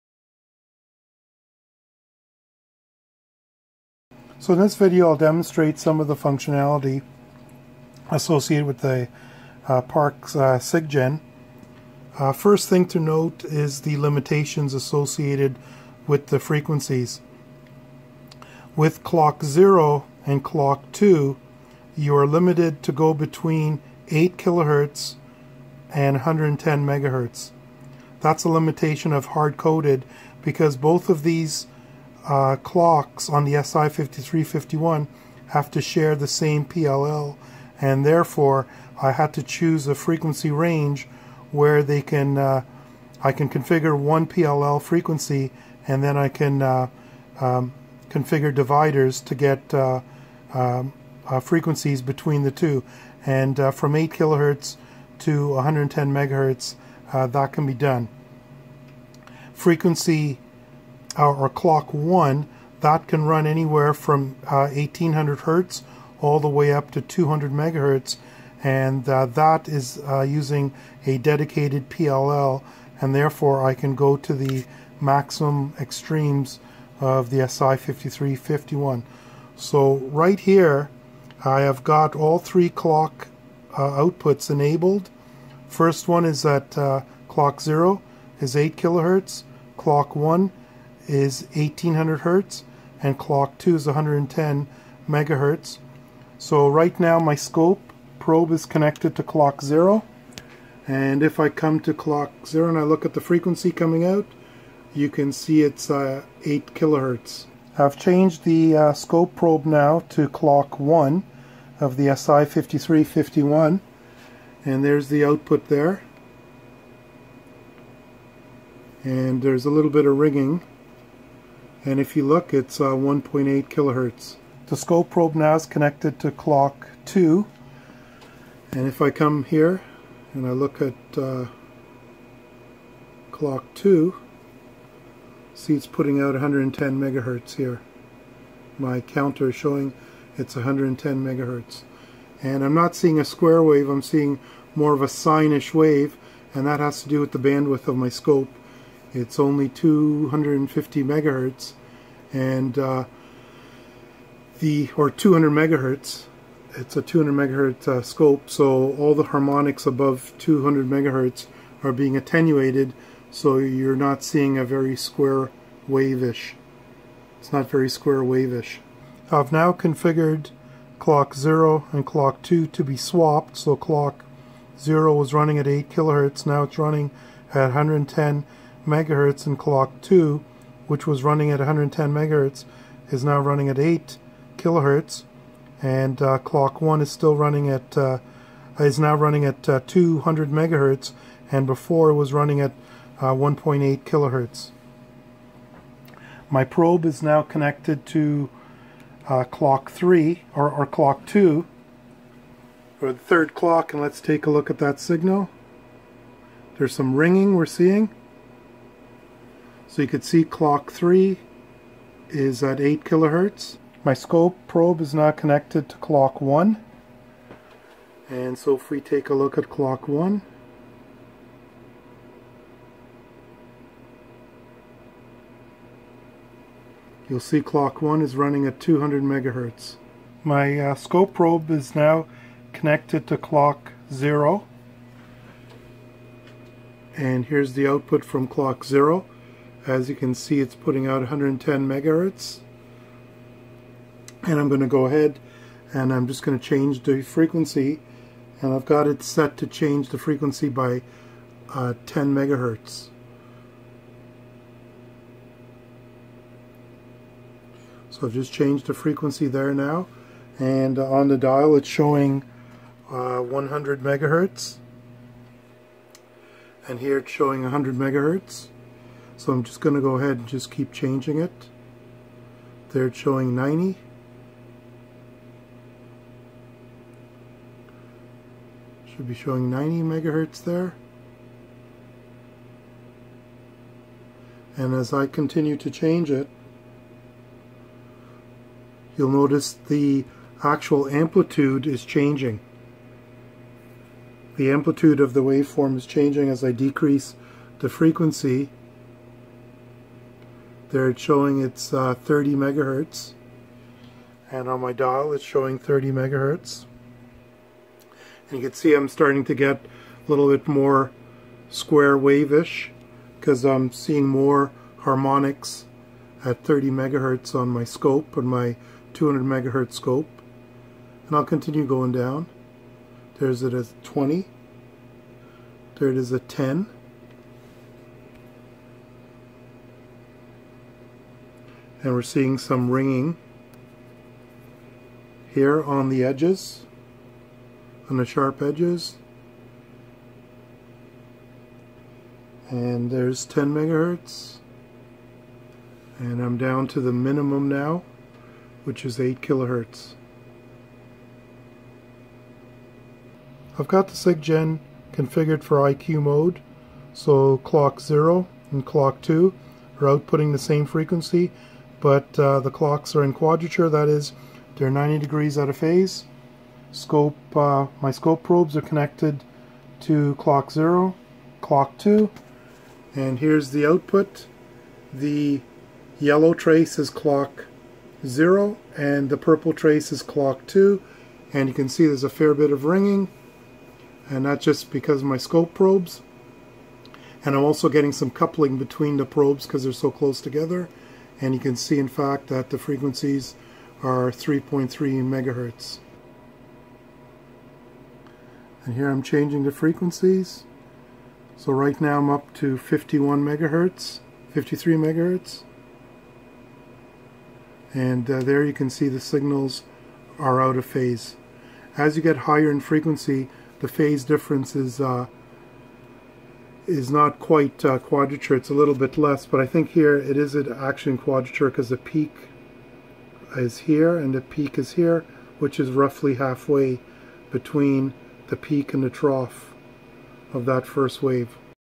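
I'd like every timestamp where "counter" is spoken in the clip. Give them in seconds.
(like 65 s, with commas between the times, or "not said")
139 s.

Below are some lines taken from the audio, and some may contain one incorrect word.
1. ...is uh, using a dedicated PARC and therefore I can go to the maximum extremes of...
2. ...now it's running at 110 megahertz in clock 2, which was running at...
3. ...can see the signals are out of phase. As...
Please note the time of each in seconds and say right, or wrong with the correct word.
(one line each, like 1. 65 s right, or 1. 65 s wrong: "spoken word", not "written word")
1. 69 s wrong: "PLL", not "PARC"
2. 176 s right
3. 408 s right.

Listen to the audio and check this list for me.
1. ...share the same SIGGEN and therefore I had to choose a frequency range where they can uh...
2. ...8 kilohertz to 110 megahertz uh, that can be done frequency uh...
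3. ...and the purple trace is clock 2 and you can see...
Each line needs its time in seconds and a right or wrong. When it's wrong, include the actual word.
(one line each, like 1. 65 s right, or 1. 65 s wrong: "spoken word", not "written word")
1. 35 s wrong: "PLL", not "SIGGEN"
2. 53 s right
3. 378 s right.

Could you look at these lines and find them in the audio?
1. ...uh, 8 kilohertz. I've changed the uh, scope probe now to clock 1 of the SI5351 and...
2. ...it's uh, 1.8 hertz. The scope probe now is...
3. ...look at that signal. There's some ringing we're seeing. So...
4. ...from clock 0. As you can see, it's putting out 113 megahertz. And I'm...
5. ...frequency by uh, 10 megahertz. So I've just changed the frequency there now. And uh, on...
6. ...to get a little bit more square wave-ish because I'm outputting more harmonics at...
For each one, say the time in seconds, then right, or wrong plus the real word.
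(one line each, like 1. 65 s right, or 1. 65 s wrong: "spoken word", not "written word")
1. 105 s right
2. 122 s wrong: "kilohertz", not "hertz"
3. 204 s right
4. 238 s wrong: "110", not "113"
5. 250 s right
6. 309 s wrong: "seeing", not "outputting".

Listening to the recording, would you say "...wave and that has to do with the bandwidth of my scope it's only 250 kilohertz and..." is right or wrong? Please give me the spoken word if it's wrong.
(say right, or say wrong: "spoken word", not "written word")
wrong: "megahertz", not "kilohertz".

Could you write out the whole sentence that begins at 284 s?
And as I continue to change it, you'll notice the actual amplitude is changing.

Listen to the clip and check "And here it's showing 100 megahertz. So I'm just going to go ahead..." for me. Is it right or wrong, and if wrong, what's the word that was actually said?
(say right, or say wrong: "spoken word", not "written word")
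right.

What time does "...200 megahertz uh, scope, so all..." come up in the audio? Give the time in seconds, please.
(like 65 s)
157 s.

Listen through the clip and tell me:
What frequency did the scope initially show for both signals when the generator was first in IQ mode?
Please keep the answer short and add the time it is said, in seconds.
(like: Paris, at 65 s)
3.3 MHz, at 394 s.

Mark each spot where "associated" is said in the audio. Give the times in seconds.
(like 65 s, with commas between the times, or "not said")
8 s, 14 s.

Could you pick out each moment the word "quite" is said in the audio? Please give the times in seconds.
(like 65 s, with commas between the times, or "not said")
417 s.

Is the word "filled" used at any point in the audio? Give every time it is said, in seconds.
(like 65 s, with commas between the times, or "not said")
not said.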